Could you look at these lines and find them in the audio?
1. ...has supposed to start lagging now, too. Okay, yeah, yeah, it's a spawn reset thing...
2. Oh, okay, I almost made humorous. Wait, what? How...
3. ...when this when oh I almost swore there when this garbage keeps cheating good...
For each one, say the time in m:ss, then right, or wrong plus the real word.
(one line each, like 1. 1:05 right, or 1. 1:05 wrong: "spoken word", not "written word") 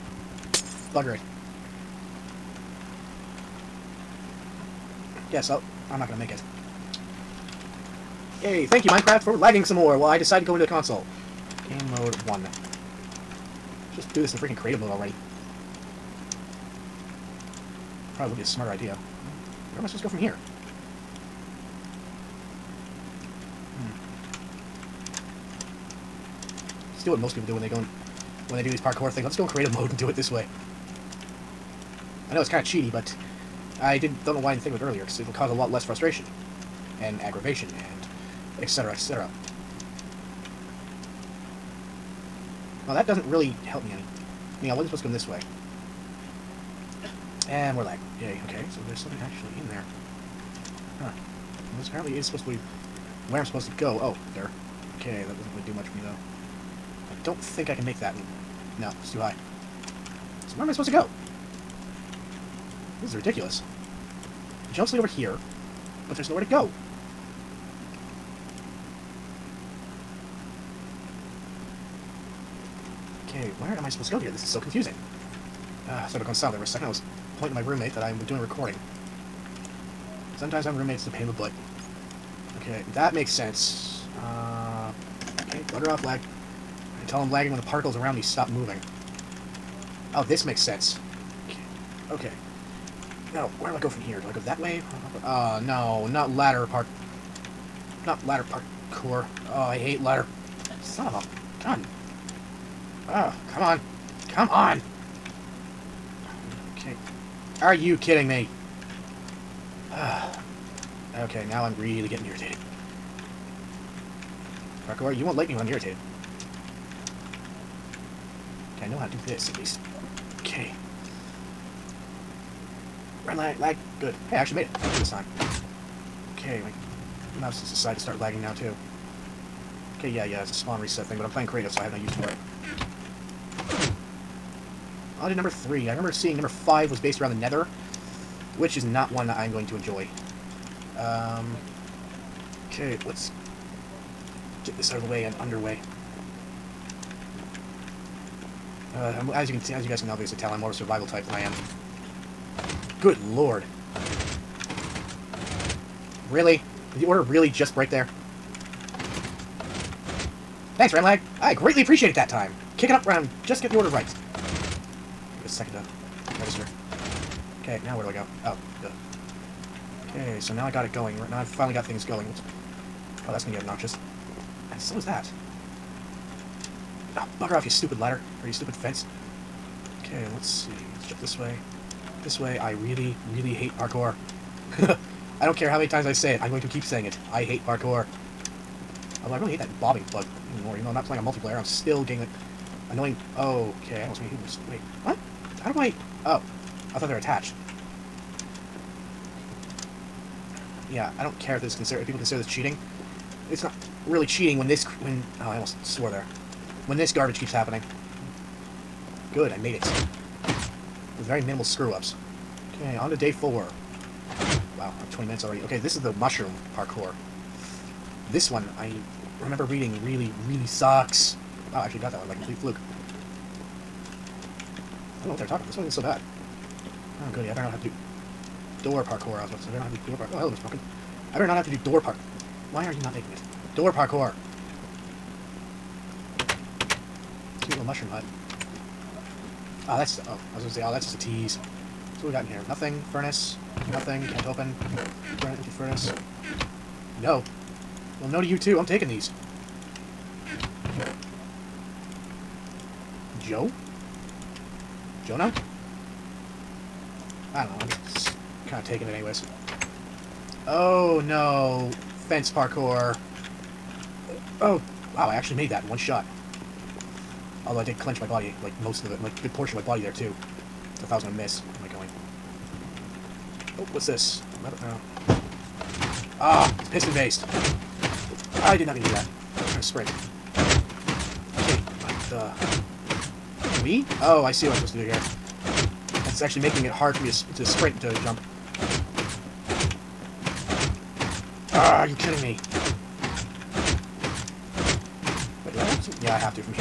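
1. 2:07 wrong: "decided", not "supposed"
2. 3:13 right
3. 3:24 wrong: "happening", not "cheating".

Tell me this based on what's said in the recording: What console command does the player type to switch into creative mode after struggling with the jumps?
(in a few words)
Game mode 1.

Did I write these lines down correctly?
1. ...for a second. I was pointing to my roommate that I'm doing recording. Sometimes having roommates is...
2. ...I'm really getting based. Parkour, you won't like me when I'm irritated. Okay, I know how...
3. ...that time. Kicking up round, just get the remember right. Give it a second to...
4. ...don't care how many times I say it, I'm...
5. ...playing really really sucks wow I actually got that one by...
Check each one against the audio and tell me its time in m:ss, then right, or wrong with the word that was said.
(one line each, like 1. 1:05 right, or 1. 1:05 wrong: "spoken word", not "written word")
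1. 1:16 right
2. 1:51 wrong: "irritated", not "based"
3. 2:42 wrong: "order", not "remember"
4. 3:05 right
5. 3:39 wrong: "reading", not "playing".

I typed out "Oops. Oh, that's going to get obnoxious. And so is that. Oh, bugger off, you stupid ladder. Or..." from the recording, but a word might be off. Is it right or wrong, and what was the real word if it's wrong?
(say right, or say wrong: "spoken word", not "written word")
right.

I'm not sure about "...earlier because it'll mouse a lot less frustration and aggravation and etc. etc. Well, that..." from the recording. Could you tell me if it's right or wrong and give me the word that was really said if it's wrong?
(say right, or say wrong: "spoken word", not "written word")
wrong: "cause", not "mouse".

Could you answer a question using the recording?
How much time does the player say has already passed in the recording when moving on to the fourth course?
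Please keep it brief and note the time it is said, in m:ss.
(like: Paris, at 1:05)
20 minutes, at 3:35.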